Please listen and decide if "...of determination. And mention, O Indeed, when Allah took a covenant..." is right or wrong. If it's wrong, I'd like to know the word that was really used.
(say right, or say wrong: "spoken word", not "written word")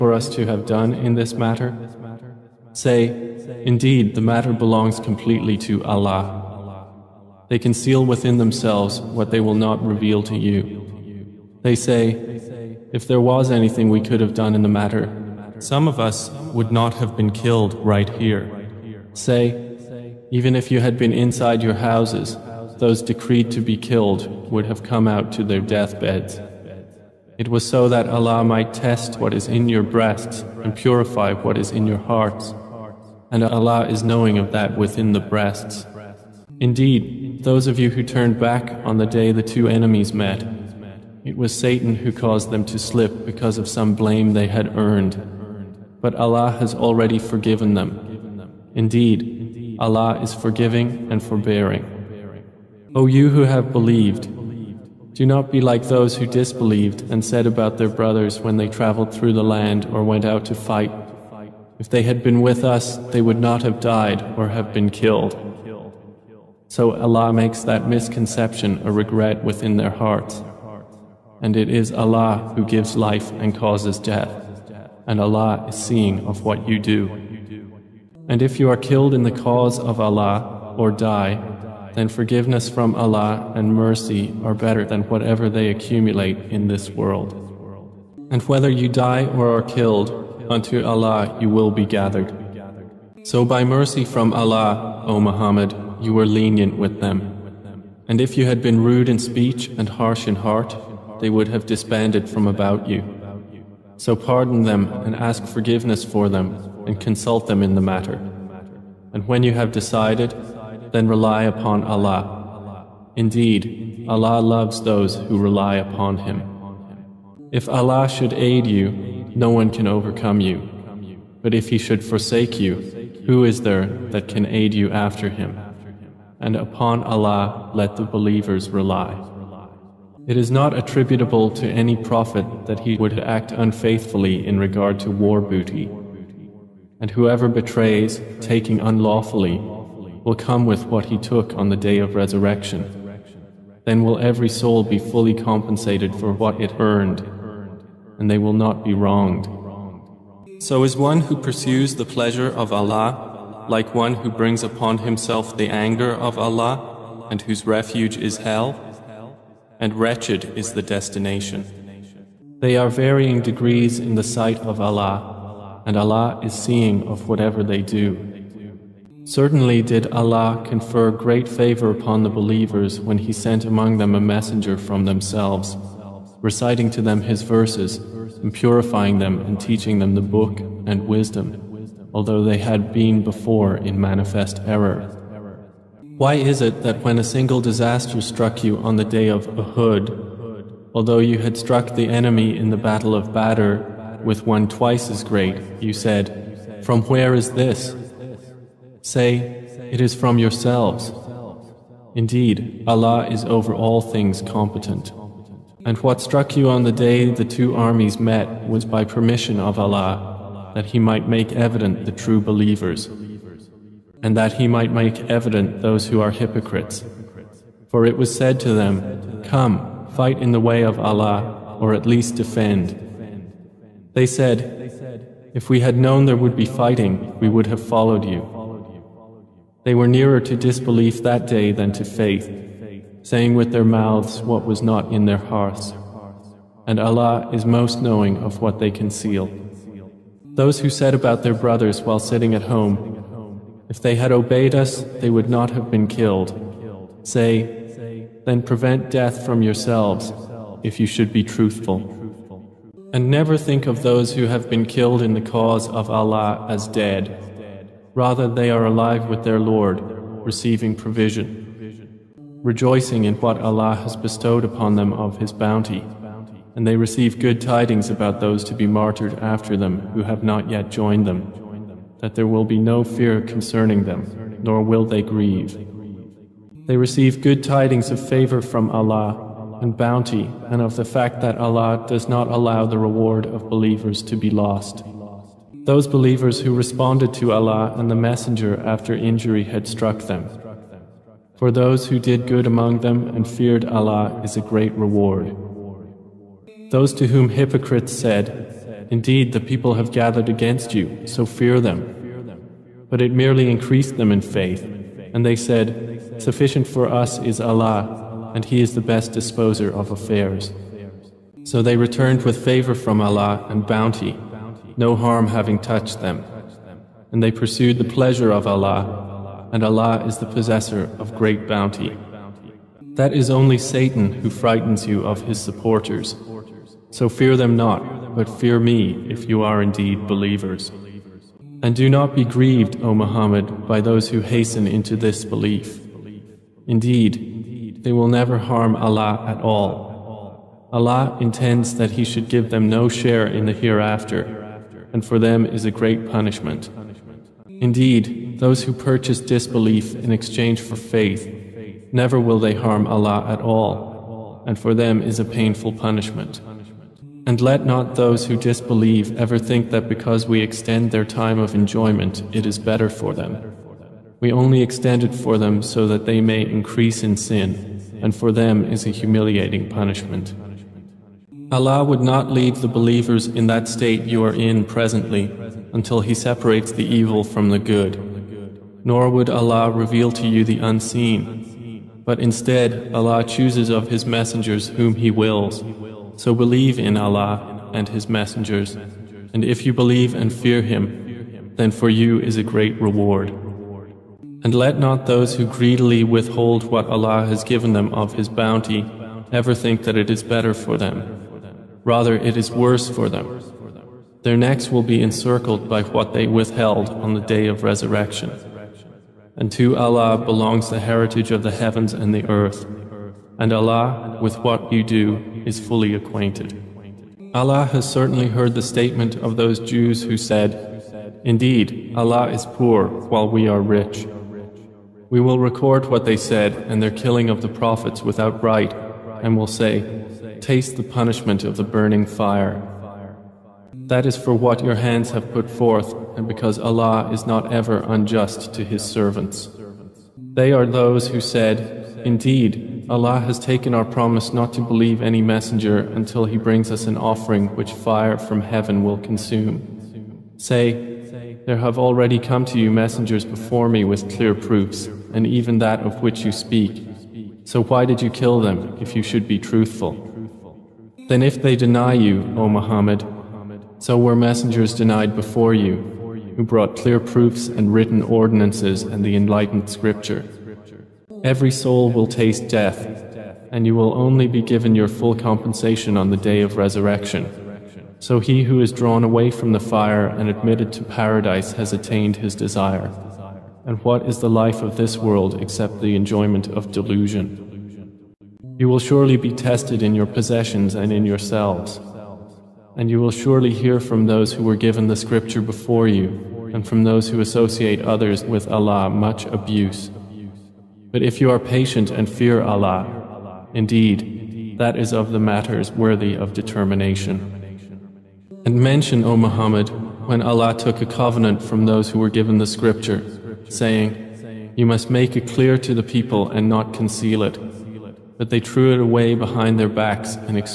wrong: "Muhammad", not "Indeed".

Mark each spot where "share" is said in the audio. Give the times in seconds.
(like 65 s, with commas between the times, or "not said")
343 s.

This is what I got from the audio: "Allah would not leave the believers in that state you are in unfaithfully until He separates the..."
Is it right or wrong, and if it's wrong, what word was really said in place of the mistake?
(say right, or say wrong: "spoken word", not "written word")
wrong: "presently", not "unfaithfully".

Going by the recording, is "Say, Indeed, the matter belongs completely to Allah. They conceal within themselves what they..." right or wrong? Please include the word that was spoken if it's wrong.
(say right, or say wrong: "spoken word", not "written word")
right.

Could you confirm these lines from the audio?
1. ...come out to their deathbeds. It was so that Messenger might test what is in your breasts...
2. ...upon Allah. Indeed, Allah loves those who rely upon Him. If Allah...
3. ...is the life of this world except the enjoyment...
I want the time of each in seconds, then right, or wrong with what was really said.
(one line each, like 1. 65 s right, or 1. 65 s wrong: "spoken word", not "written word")
1. 24 s wrong: "Allah", not "Messenger"
2. 111 s right
3. 484 s right.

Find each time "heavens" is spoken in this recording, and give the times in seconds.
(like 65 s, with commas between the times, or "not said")
411 s, 448 s.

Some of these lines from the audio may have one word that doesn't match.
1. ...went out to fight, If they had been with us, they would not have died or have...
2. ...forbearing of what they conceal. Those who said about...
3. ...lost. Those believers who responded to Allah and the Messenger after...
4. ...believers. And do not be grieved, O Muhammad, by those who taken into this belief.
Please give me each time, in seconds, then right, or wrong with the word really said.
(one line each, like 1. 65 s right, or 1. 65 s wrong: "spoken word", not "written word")
1. 60 s right
2. 238 s wrong: "knowing", not "forbearing"
3. 284 s right
4. 330 s wrong: "hasten", not "taken".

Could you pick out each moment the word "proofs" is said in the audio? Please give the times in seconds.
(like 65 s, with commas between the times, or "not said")
454 s, 467 s.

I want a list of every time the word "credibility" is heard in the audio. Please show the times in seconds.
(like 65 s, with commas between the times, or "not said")
not said.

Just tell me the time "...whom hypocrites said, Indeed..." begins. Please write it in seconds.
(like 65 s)
297 s.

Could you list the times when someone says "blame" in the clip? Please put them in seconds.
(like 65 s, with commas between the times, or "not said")
43 s.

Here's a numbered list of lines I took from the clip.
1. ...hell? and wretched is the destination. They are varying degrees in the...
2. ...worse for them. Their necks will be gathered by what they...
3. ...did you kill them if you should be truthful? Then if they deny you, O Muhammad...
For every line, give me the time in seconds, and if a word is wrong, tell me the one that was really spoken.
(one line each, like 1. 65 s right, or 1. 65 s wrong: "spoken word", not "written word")
1. 158 s right
2. 402 s wrong: "encircled", not "gathered"
3. 458 s right.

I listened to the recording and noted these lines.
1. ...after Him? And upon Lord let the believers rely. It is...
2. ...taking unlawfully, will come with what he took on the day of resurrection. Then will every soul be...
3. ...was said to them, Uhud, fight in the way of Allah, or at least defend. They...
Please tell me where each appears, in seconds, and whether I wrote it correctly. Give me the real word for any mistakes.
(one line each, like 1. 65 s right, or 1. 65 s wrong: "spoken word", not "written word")
1. 124 s wrong: "Allah", not "Lord"
2. 138 s right
3. 218 s wrong: "Come", not "Uhud".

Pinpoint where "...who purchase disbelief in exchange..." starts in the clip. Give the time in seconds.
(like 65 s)
348 s.